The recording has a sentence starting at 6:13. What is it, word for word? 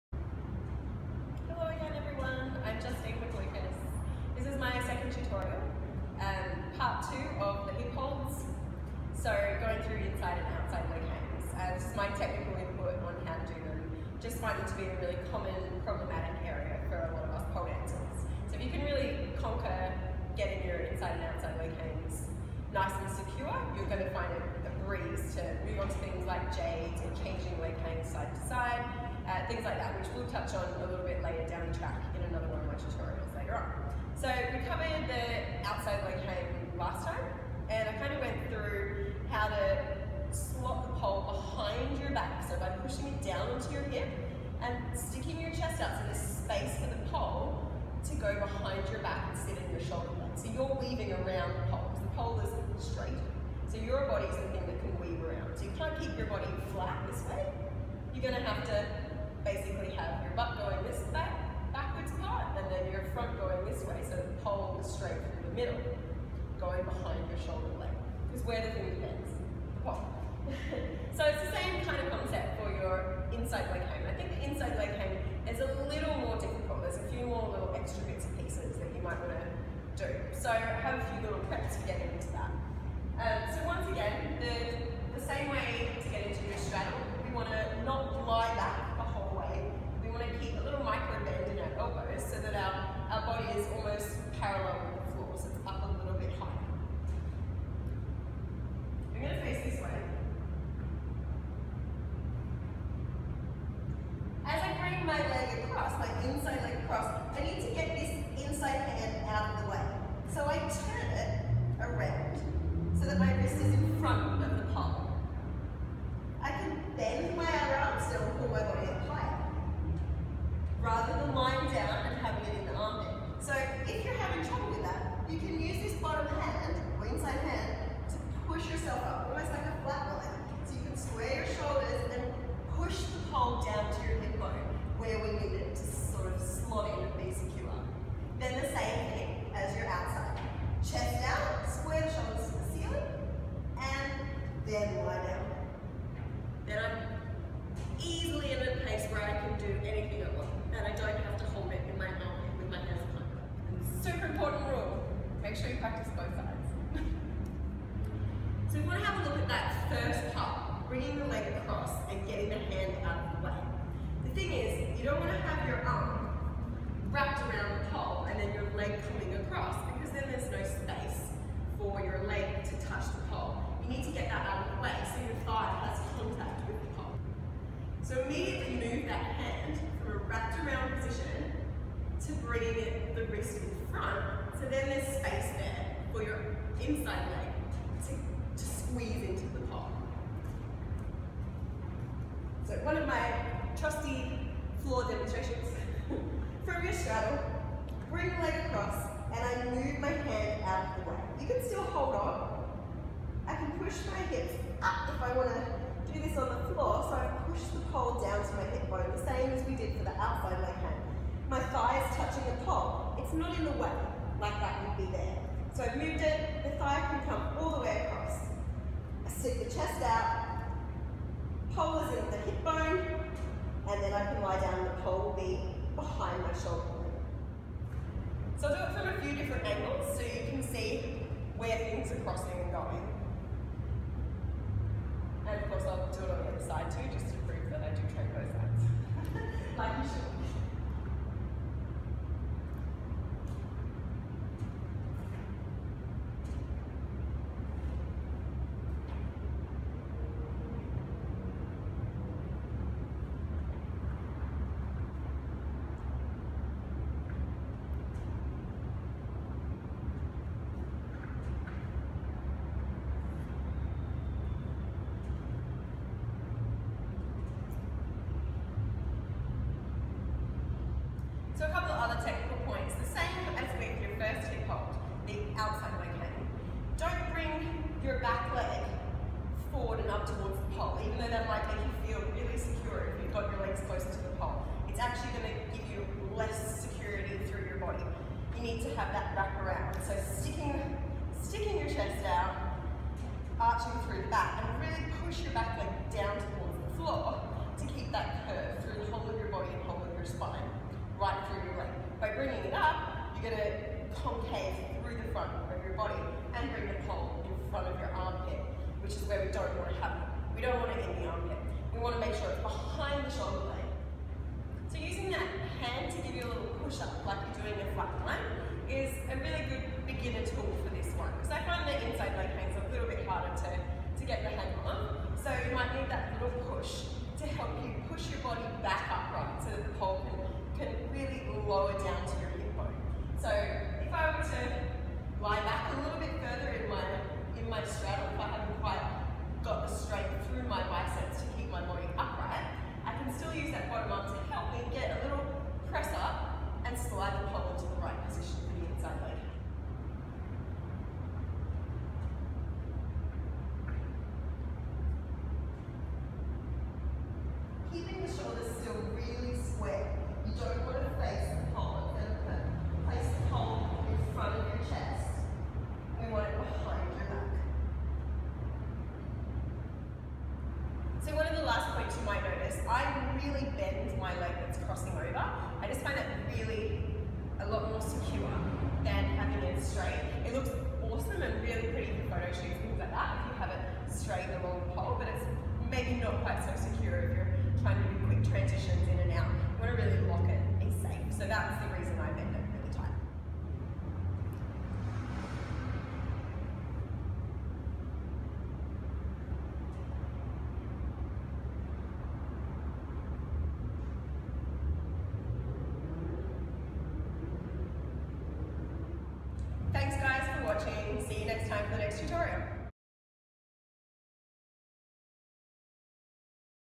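really bend my leg that's crossing over.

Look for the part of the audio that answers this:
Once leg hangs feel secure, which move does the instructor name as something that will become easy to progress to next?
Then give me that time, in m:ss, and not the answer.
0:26.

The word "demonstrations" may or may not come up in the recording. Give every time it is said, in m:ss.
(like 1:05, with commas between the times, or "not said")
3:15.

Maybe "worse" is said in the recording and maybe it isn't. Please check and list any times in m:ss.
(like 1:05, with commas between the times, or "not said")
not said.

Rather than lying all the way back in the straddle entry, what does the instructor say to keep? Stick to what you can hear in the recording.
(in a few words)
a little micro.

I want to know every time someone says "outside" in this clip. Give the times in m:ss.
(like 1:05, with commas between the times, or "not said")
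0:10, 0:21, 0:35.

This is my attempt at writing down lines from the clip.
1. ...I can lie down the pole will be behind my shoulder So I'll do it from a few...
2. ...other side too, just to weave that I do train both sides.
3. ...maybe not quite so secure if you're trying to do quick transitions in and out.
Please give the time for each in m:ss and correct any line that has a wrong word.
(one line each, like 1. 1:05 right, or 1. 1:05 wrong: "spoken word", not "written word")
1. 3:44 right
2. 3:56 wrong: "prove", not "weave"
3. 6:25 right.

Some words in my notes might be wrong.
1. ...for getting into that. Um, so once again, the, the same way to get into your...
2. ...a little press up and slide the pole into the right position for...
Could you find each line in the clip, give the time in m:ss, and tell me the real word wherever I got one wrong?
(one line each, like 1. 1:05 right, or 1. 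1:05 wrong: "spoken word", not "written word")
1. 1:21 right
2. 5:45 right.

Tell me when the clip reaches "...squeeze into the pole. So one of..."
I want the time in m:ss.
3:08.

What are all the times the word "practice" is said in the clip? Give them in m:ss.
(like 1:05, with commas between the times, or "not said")
2:35.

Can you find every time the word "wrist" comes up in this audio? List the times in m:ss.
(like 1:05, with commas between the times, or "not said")
1:53, 3:03.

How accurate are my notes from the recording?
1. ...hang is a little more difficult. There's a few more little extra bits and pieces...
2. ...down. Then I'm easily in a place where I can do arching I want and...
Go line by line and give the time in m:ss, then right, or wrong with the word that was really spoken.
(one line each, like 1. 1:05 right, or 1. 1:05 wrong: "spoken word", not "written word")
1. 1:14 right
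2. 2:25 wrong: "anything", not "arching".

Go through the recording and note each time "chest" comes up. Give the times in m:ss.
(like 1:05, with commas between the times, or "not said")
0:45, 3:39, 4:51.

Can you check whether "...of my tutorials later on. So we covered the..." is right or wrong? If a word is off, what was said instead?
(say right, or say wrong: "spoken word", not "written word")
right.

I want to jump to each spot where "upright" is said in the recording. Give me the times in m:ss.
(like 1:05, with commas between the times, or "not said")
5:42.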